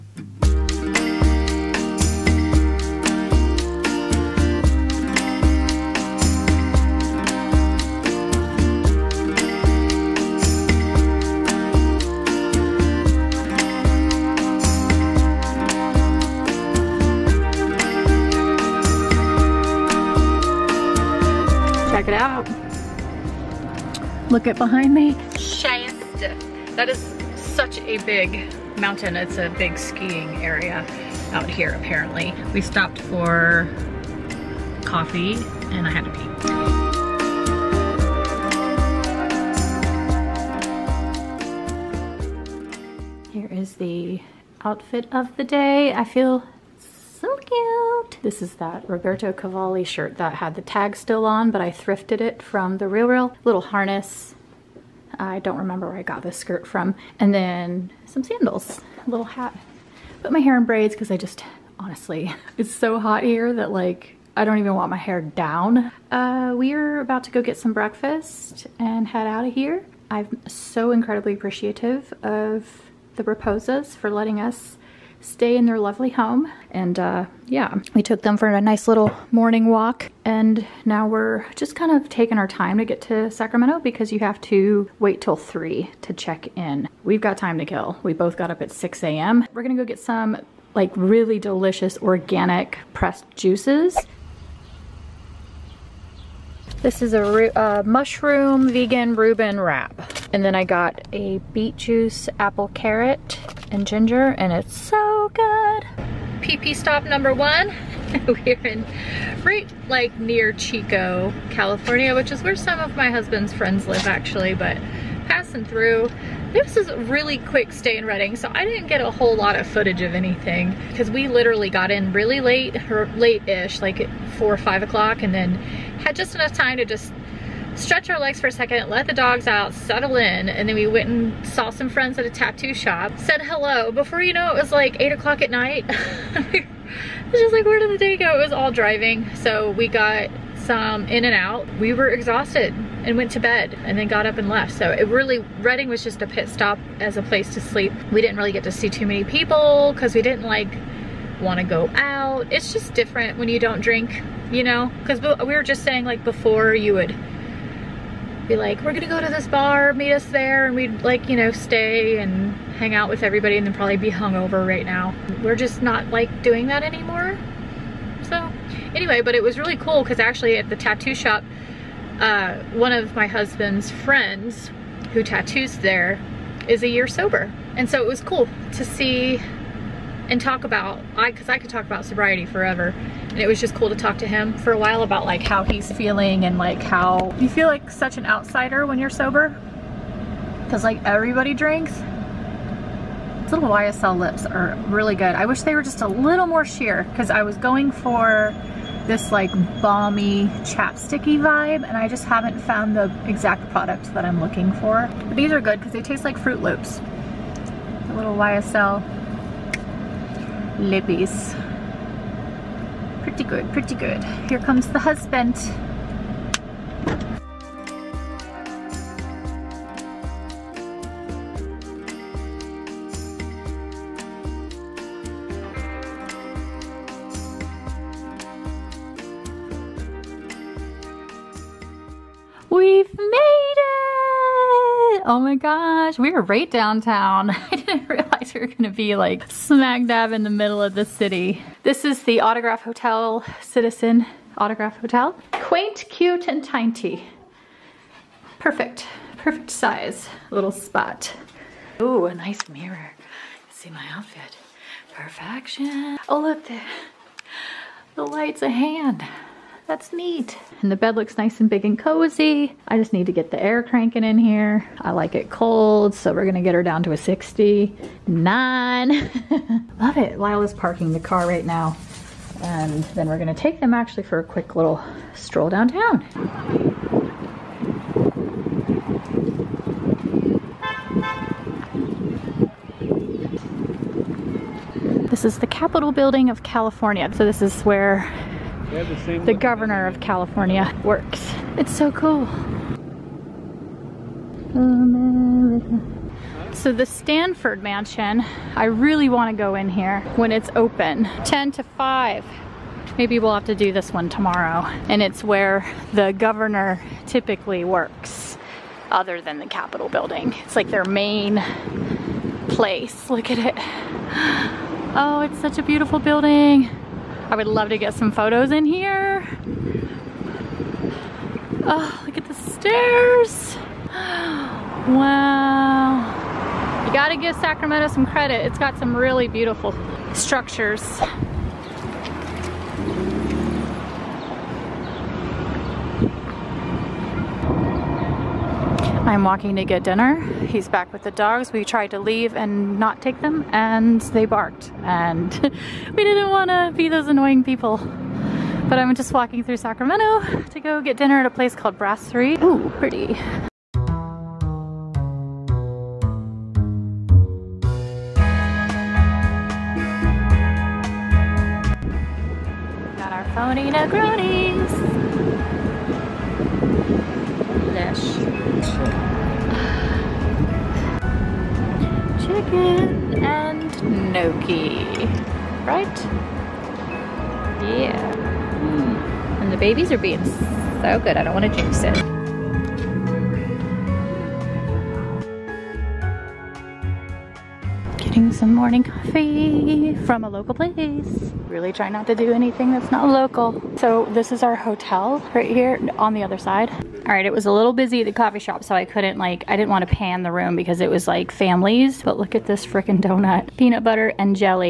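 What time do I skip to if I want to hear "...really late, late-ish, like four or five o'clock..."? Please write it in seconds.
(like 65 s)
122 s.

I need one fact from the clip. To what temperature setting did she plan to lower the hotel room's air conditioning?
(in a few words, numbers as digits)
69.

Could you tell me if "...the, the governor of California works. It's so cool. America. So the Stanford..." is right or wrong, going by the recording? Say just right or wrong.
right.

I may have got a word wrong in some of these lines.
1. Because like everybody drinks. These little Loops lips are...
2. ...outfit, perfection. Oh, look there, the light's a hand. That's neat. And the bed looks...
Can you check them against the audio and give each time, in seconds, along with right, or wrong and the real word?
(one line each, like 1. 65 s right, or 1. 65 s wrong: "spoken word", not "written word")
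1. 190 s wrong: "YSL", not "Loops"
2. 254 s right.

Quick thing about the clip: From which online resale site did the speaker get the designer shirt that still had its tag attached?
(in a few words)
The Real Real.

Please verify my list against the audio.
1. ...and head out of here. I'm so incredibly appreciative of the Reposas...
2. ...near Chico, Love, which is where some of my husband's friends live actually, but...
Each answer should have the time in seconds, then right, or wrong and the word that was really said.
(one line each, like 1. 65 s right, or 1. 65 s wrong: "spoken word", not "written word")
1. 68 s right
2. 110 s wrong: "California", not "Love".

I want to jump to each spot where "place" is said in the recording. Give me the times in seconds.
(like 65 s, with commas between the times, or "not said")
147 s, 312 s, 351 s, 390 s.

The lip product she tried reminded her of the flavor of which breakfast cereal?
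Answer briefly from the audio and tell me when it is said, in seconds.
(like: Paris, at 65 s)
Froot Loops, at 206 s.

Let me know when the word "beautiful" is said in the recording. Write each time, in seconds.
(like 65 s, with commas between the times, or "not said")
315 s, 329 s.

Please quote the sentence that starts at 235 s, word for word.
Oh my gosh, we are right downtown.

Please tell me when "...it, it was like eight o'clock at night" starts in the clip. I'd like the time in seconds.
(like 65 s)
134 s.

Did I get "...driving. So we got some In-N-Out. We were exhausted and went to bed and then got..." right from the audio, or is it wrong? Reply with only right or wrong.
right.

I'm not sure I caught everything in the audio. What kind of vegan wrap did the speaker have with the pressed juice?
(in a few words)
Mushroom vegan Reuben.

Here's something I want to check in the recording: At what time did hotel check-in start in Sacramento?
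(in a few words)
3.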